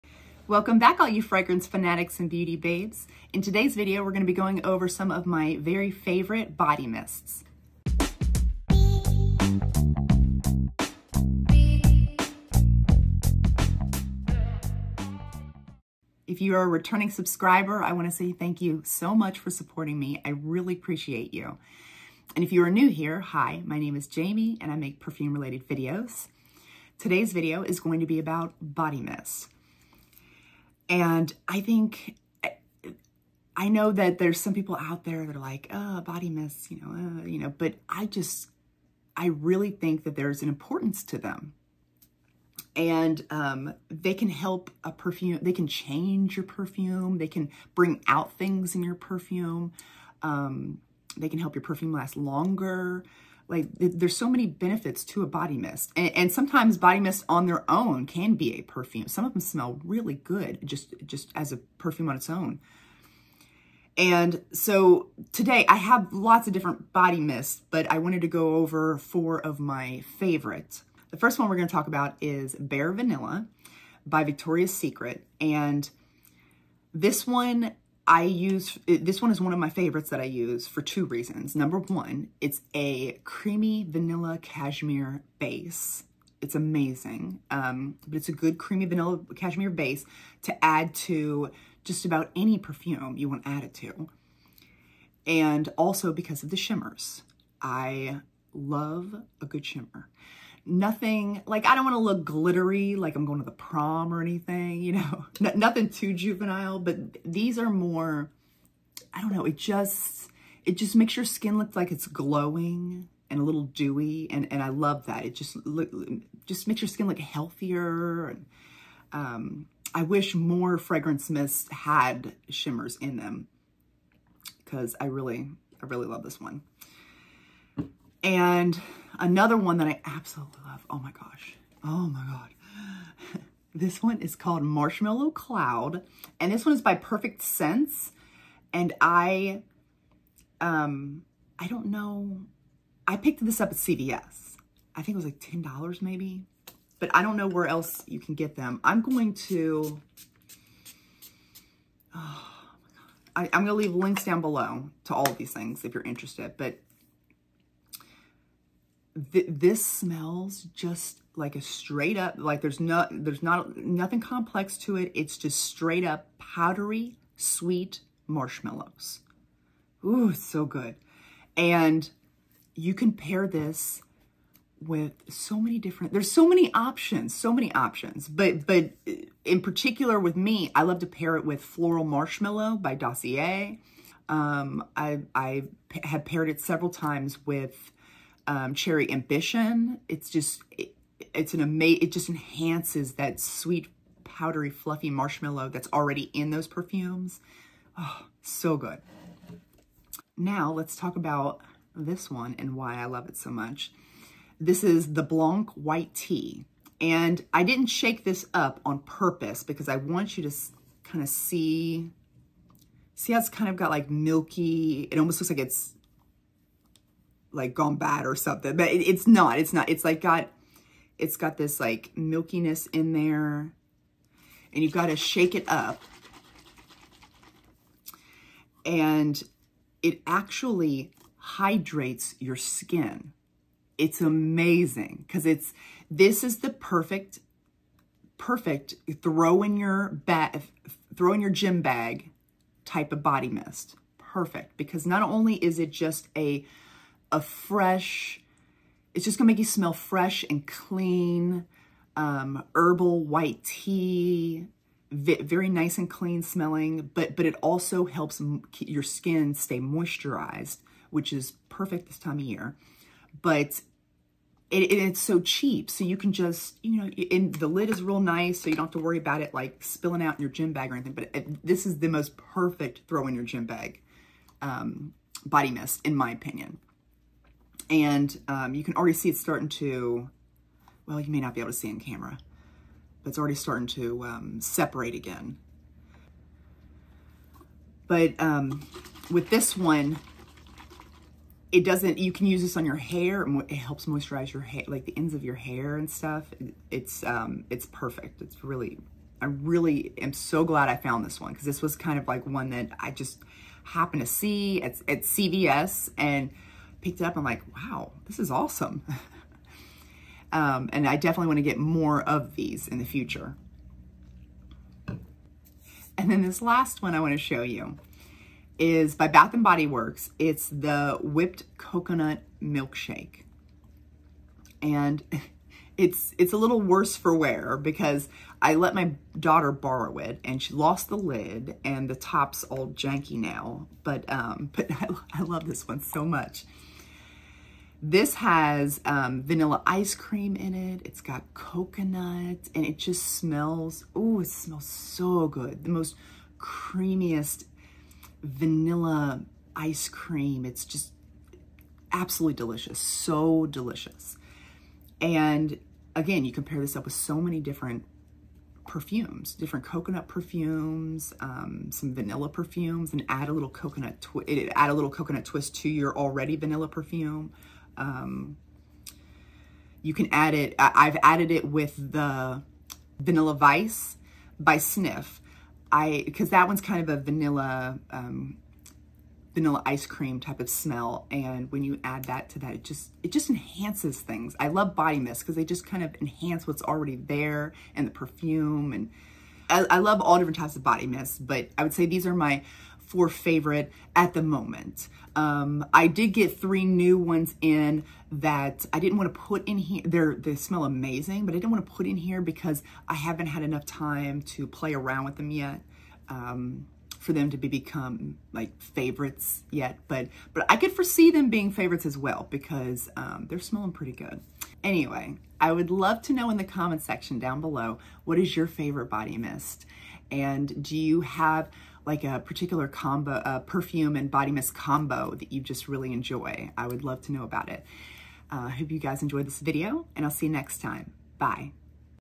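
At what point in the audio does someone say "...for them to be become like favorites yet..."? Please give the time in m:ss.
6:47.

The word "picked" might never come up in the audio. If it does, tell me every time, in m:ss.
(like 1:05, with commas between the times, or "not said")
2:23, 5:07.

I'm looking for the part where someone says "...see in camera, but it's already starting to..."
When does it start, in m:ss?
4:41.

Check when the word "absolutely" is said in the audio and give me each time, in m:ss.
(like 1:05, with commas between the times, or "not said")
2:10, 5:52.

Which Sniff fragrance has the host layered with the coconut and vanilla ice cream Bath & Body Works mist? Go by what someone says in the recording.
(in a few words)
Vanilla Vice.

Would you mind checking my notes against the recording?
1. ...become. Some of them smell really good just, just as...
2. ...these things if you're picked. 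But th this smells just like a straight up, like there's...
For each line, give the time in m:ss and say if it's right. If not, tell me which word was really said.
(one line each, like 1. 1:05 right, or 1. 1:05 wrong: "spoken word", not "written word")
1. 0:58 wrong: "perfume", not "become"
2. 2:35 wrong: "interested", not "picked".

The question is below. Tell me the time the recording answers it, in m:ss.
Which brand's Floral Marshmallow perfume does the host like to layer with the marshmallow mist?
3:02.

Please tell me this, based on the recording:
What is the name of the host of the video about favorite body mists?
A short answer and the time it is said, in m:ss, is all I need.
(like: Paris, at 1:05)
Jamie, at 0:24.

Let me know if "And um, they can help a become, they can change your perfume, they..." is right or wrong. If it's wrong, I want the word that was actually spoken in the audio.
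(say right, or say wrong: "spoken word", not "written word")
wrong: "perfume", not "become".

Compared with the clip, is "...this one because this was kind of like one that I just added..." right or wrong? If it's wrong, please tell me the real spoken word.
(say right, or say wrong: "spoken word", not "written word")
wrong: "happened", not "added".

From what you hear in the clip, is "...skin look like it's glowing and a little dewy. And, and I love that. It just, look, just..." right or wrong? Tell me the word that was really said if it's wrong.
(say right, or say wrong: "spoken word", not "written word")
right.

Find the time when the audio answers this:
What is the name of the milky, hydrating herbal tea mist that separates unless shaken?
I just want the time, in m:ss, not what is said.
3:25.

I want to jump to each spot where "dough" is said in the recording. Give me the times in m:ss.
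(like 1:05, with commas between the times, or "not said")
not said.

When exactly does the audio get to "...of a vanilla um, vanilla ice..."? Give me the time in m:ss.
6:17.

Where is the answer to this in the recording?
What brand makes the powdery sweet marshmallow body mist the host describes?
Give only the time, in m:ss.
2:16.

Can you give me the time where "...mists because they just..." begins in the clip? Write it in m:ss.
6:25.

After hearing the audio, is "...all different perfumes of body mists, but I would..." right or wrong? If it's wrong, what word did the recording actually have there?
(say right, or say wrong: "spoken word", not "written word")
wrong: "types", not "perfumes".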